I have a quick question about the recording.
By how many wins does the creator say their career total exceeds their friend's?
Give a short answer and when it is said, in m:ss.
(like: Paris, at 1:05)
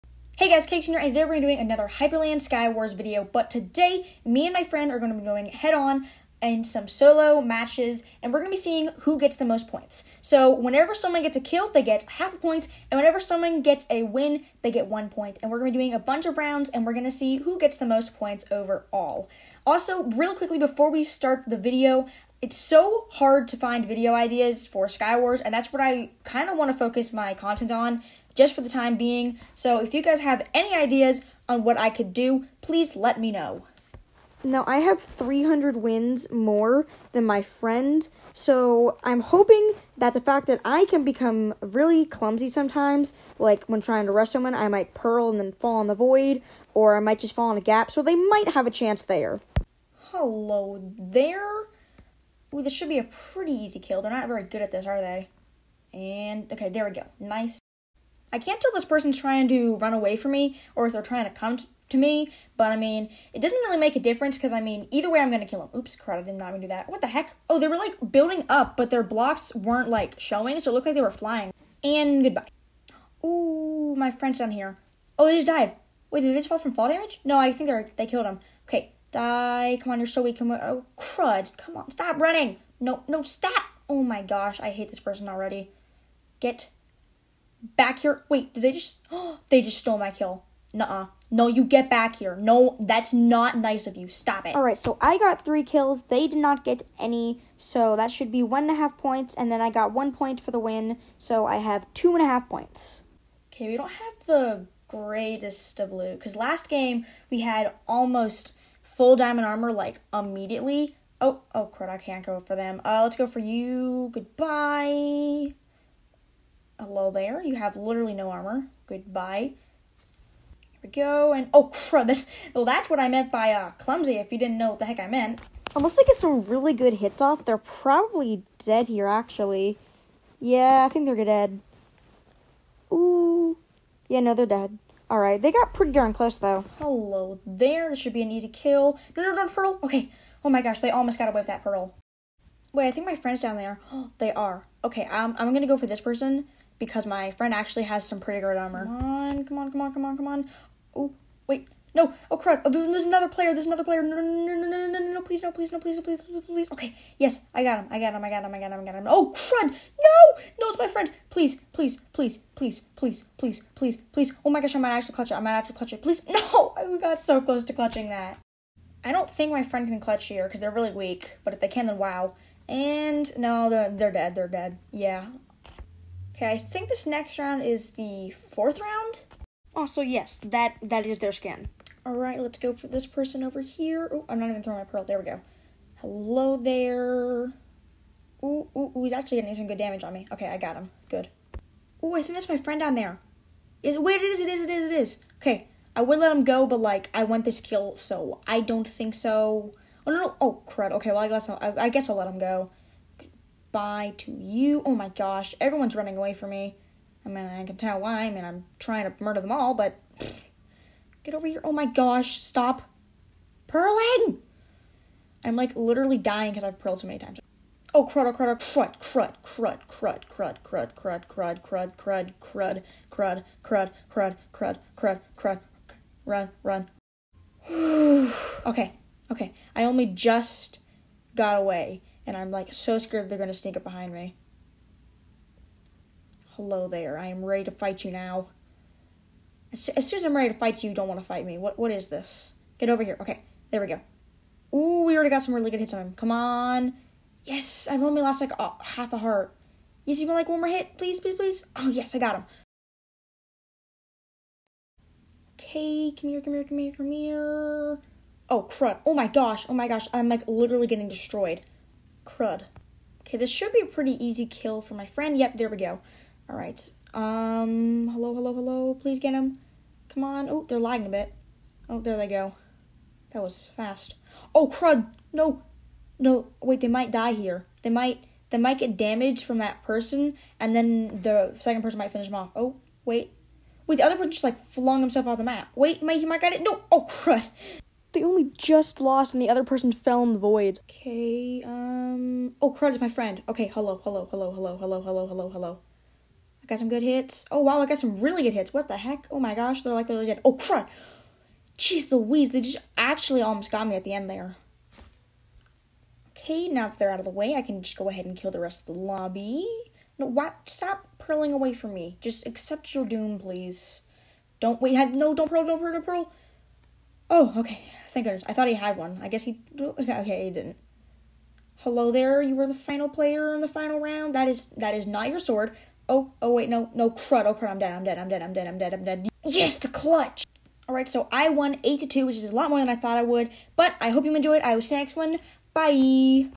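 300, at 0:34.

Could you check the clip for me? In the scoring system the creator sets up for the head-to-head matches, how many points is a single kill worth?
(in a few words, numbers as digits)
half a point.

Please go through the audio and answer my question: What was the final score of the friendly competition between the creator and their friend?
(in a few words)
8 to 2.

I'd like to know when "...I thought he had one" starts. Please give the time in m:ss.
5:18.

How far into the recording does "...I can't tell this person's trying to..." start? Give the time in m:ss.
0:58.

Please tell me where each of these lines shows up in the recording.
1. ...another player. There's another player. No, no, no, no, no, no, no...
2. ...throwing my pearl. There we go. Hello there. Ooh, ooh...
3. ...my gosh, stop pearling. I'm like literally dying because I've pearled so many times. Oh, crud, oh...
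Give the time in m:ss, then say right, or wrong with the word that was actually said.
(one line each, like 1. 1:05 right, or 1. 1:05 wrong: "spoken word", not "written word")
1. 2:33 right
2. 3:04 right
3. 3:31 right.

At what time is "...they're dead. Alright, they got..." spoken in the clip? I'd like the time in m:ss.
2:14.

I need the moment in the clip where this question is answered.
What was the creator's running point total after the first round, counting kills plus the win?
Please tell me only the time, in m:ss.
1:41.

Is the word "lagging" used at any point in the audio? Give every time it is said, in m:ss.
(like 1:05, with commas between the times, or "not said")
4:30.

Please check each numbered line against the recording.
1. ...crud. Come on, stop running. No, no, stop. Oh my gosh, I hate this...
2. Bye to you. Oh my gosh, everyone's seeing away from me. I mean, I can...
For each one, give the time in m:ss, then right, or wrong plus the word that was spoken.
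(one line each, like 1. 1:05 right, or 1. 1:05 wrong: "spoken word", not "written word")
1. 1:20 right
2. 3:23 wrong: "running", not "seeing".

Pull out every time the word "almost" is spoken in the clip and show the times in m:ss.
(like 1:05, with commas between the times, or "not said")
1:47, 2:20, 5:03.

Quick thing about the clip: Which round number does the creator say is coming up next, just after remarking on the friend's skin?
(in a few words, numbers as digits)
fourth.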